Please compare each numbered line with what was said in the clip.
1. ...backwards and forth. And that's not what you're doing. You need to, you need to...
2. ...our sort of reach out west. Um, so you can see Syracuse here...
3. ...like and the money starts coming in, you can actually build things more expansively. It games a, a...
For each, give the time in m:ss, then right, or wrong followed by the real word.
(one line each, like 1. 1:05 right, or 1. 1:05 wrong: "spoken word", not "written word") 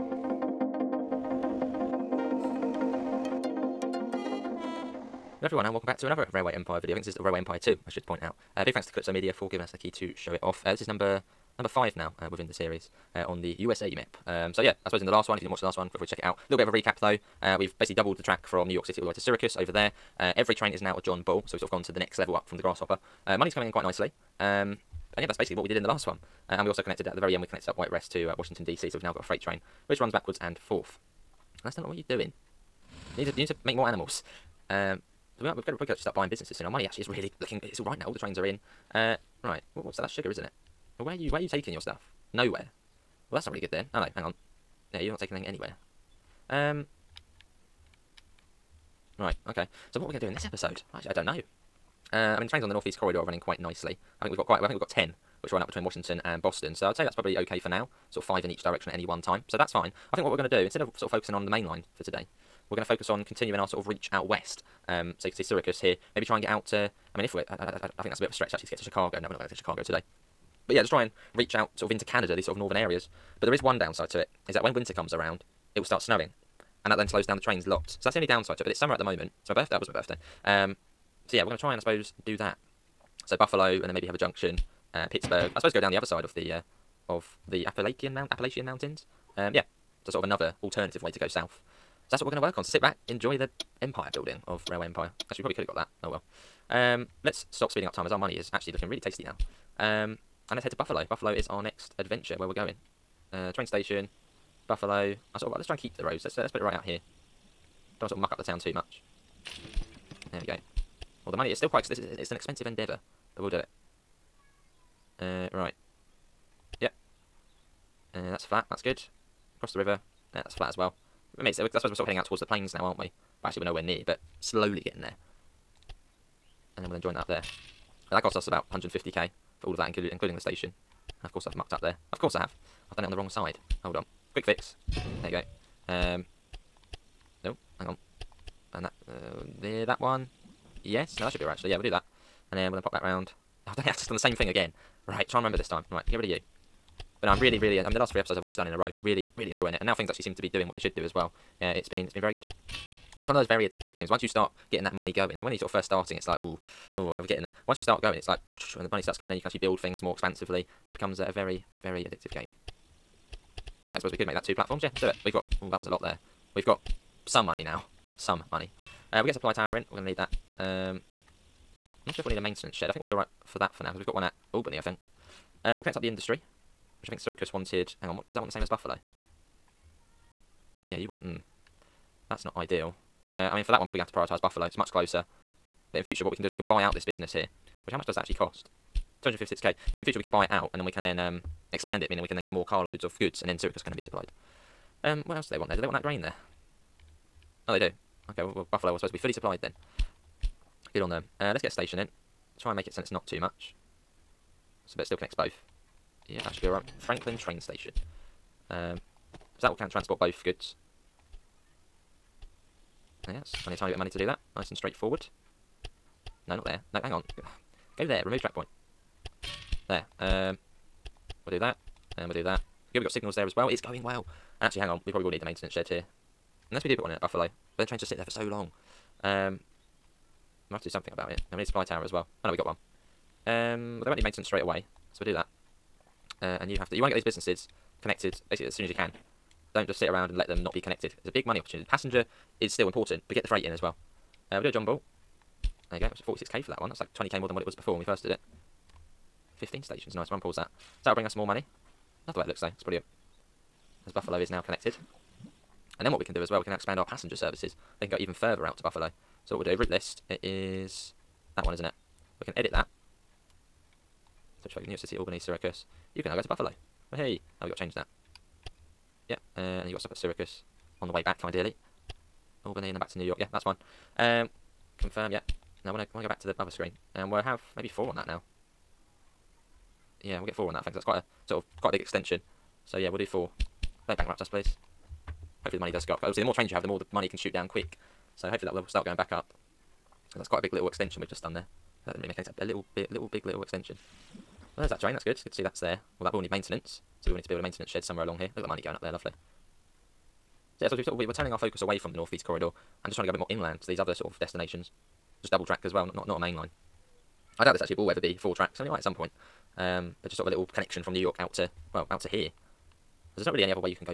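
1. 0:30 right
2. 1:03 right
3. 2:38 wrong: "becomes", not "games".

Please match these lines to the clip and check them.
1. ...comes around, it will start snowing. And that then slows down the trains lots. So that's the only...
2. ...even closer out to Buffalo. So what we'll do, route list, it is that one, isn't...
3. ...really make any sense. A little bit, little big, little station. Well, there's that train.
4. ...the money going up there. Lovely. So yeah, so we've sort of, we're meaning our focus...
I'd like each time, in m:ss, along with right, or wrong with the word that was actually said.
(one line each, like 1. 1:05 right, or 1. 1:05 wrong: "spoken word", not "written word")
1. 1:14 right
2. 4:18 wrong: "further", not "closer"
3. 4:52 wrong: "extension", not "station"
4. 4:58 wrong: "turning", not "meaning".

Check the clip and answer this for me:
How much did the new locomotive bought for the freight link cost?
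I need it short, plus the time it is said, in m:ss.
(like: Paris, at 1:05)
46k, at 4:06.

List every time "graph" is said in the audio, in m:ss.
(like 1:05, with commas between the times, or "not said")
not said.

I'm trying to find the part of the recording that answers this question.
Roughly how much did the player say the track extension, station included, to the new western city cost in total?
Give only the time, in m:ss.
2:08.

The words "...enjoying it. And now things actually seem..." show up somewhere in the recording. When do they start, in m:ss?
2:29.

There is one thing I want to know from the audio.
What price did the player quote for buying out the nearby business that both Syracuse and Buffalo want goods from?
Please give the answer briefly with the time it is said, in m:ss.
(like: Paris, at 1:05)
256k, at 3:09.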